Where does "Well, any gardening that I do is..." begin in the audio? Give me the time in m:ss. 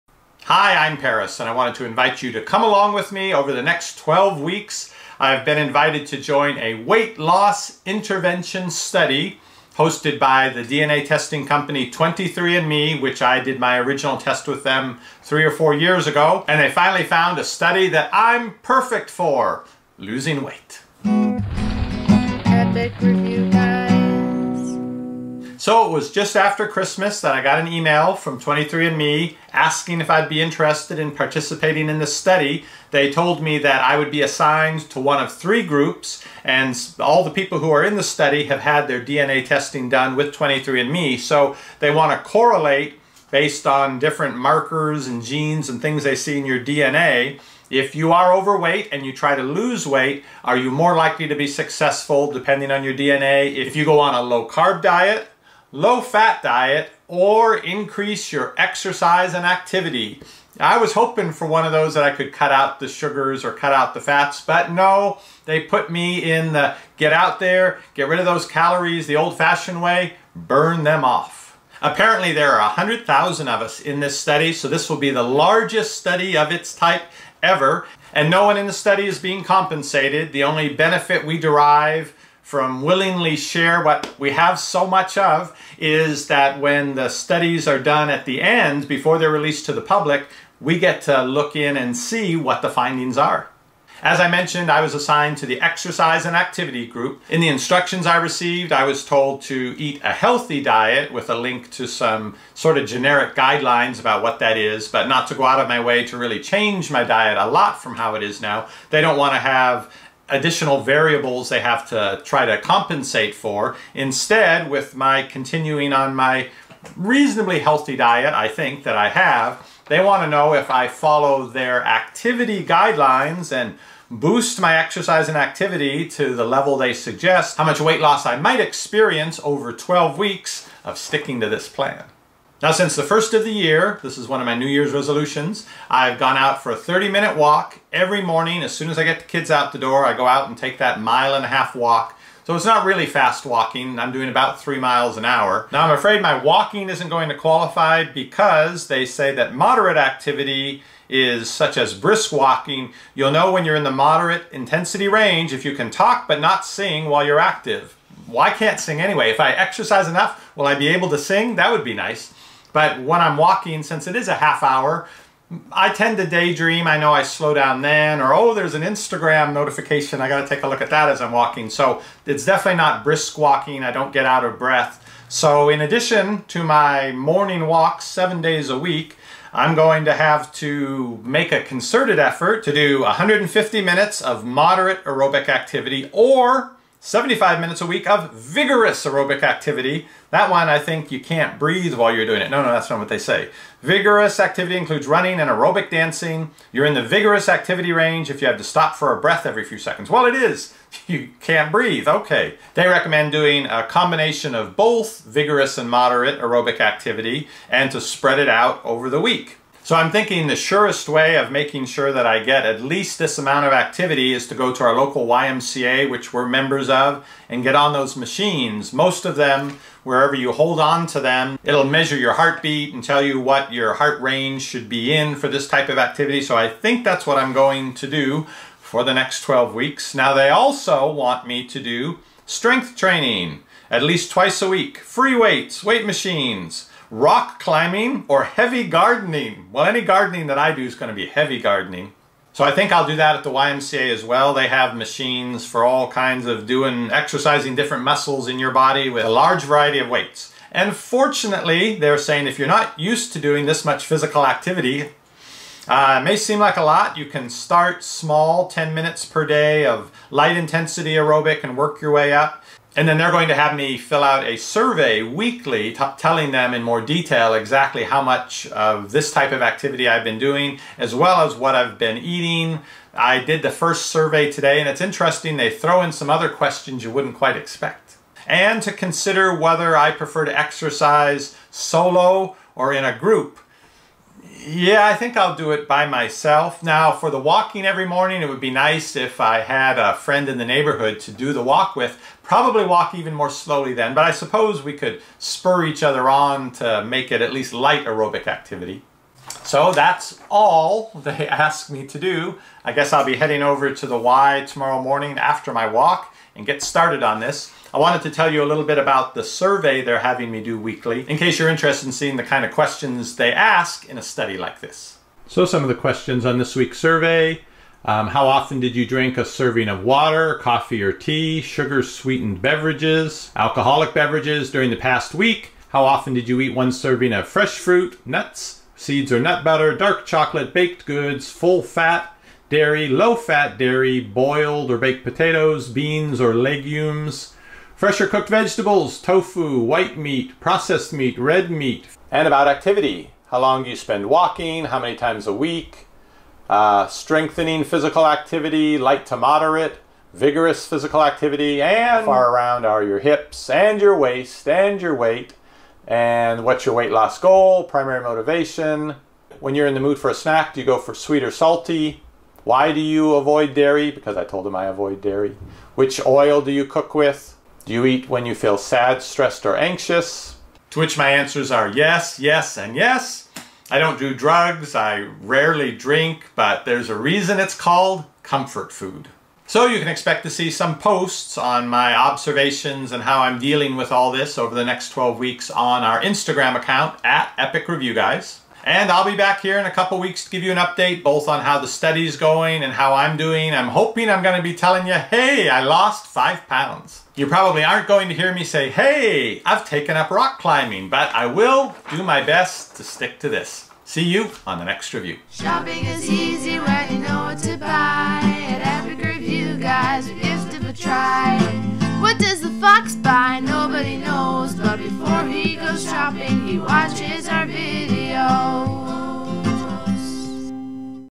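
3:59.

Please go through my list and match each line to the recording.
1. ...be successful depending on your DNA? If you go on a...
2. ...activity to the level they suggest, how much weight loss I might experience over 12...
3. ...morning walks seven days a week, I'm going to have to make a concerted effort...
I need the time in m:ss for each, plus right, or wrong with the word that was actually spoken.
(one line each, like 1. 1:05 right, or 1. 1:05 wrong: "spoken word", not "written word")
1. 0:51 right
2. 2:05 right
3. 2:57 right.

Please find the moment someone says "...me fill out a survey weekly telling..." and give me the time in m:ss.
4:23.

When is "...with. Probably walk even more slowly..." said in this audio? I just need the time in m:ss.
4:51.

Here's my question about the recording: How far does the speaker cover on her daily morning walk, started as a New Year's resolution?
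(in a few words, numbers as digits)
1.5 miles.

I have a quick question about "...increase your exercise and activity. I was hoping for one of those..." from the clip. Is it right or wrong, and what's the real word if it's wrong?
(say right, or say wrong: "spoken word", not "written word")
right.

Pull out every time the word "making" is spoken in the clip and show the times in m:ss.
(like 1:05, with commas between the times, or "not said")
3:31.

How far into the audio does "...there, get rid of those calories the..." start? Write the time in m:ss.
1:07.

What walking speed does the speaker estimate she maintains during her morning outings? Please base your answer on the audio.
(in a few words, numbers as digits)
3 miles an hour.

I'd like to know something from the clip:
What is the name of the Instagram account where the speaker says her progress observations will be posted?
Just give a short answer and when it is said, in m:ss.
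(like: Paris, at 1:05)
Epic Review Guys, at 6:27.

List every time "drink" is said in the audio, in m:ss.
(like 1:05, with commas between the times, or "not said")
5:19, 6:15.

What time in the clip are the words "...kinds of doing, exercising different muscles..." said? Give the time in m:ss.
4:06.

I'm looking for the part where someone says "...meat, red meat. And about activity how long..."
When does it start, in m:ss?
5:41.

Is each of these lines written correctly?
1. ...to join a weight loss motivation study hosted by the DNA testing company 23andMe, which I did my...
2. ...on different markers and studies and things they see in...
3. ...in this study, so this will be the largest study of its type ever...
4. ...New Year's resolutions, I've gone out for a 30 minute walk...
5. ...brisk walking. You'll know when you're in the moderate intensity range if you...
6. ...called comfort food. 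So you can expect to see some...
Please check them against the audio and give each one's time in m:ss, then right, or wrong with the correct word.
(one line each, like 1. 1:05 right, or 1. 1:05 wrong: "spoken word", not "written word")
1. 0:06 wrong: "intervention", not "motivation"
2. 0:43 wrong: "genes", not "studies"
3. 1:13 right
4. 2:14 right
5. 2:31 right
6. 6:17 right.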